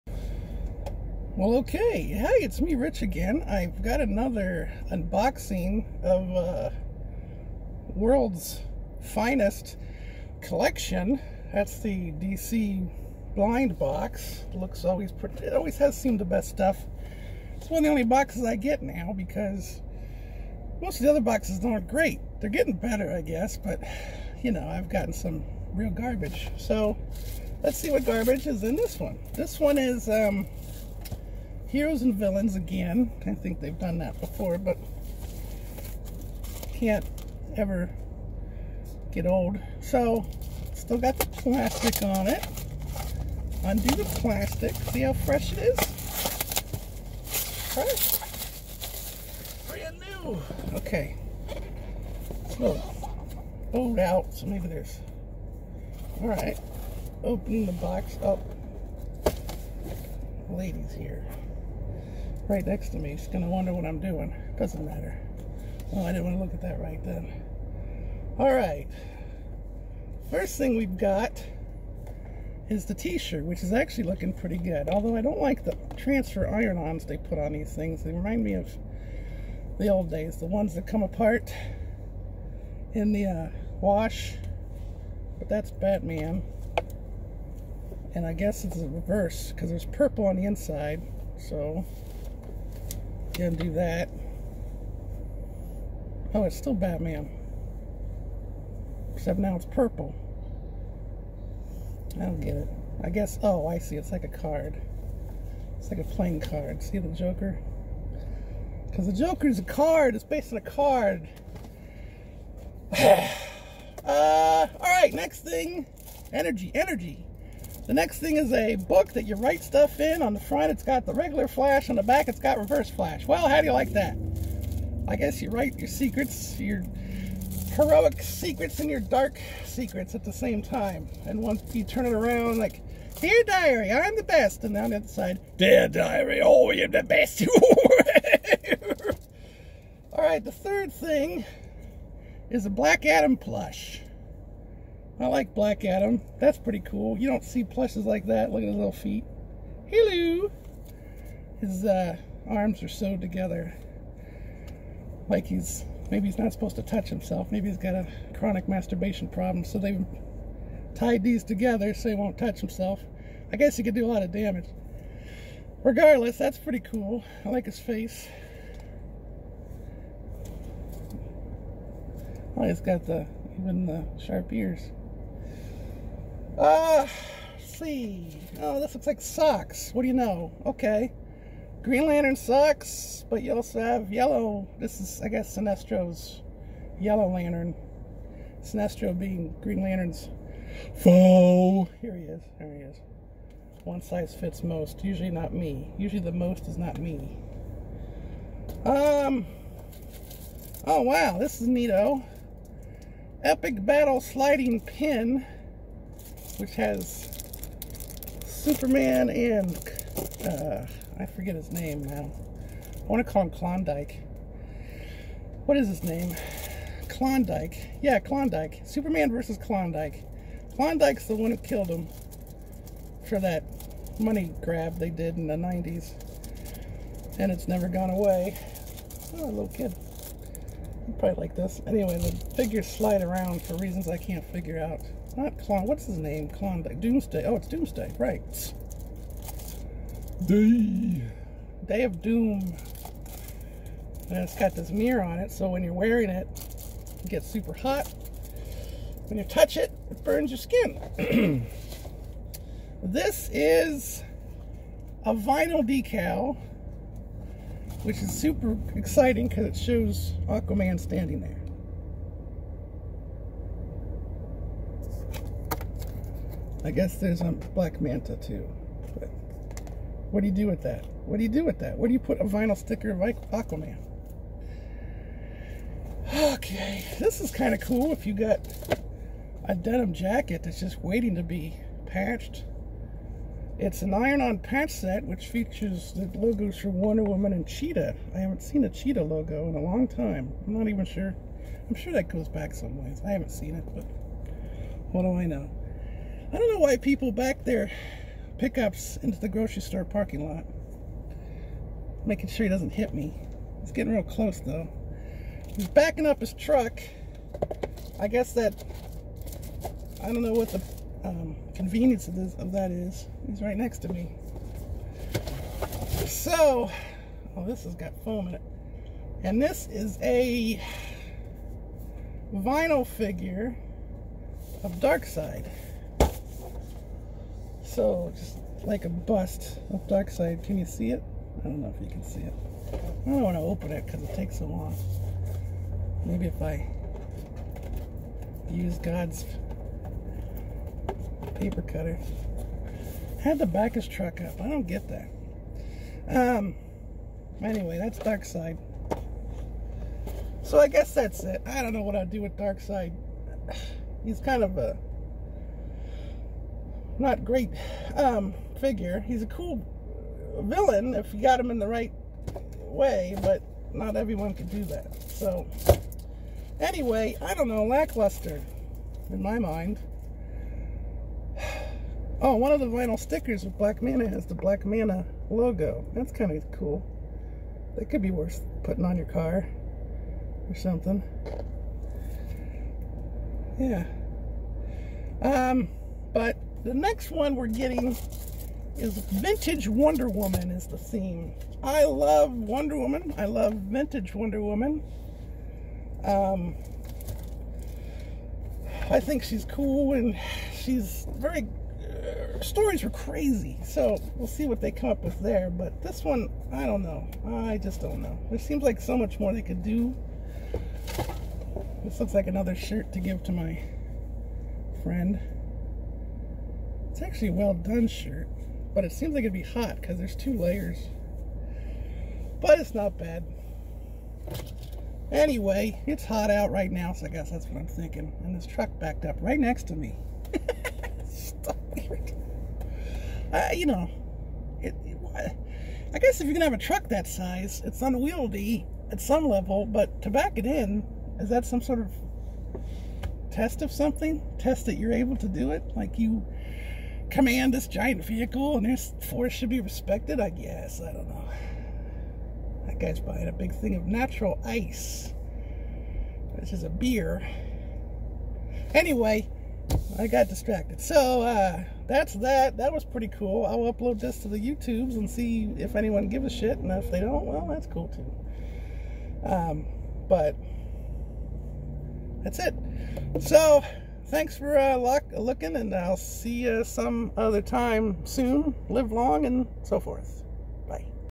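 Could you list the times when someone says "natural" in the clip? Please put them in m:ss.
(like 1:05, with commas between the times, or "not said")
7:34.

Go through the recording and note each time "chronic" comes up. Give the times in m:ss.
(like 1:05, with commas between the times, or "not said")
2:38.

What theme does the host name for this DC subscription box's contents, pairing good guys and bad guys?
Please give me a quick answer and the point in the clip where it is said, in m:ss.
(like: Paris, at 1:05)
Heroes and Villains, at 0:31.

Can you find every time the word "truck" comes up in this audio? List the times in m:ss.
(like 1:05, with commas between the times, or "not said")
5:06, 5:44, 7:08, 7:16.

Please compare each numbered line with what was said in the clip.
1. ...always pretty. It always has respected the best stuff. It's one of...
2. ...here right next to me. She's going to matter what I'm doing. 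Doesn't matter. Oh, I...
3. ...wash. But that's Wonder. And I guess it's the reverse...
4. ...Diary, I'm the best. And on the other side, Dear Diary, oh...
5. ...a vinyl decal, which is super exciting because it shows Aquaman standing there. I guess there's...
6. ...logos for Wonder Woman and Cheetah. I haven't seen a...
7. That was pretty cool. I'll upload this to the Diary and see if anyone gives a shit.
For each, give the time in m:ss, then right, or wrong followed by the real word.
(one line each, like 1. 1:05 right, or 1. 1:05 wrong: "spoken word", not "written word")
1. 0:14 wrong: "seemed", not "respected"
2. 1:00 wrong: "wonder", not "matter"
3. 1:23 wrong: "Batman", not "Wonder"
4. 2:13 right
5. 4:15 right
6. 4:46 right
7. 7:42 wrong: "YouTubes", not "Diary".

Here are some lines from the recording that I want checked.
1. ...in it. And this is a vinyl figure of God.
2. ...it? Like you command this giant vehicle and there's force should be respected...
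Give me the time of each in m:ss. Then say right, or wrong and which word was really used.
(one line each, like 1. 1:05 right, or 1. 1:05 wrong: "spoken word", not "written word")
1. 5:18 wrong: "Darkseid", not "God"
2. 7:25 right.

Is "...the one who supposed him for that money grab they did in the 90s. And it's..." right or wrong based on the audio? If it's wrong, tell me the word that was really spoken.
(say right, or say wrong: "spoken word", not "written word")
wrong: "killed", not "supposed".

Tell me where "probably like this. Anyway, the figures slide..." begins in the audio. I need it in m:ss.
3:51.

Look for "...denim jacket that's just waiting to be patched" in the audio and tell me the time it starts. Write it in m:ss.
4:39.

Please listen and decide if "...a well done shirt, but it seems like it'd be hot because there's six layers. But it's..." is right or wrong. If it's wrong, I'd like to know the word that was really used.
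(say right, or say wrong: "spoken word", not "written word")
wrong: "two", not "six".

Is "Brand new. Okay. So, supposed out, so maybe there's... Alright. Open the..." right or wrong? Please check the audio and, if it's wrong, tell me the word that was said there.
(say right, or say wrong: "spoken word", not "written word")
wrong: "bowed", not "supposed".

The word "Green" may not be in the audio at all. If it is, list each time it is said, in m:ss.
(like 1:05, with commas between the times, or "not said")
3:01, 3:09.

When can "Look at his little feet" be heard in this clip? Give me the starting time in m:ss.
2:28.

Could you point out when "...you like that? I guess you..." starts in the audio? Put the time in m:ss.
2:03.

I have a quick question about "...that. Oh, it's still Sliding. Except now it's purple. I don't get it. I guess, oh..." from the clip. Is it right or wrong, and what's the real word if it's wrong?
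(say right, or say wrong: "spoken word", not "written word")
wrong: "Batman", not "Sliding".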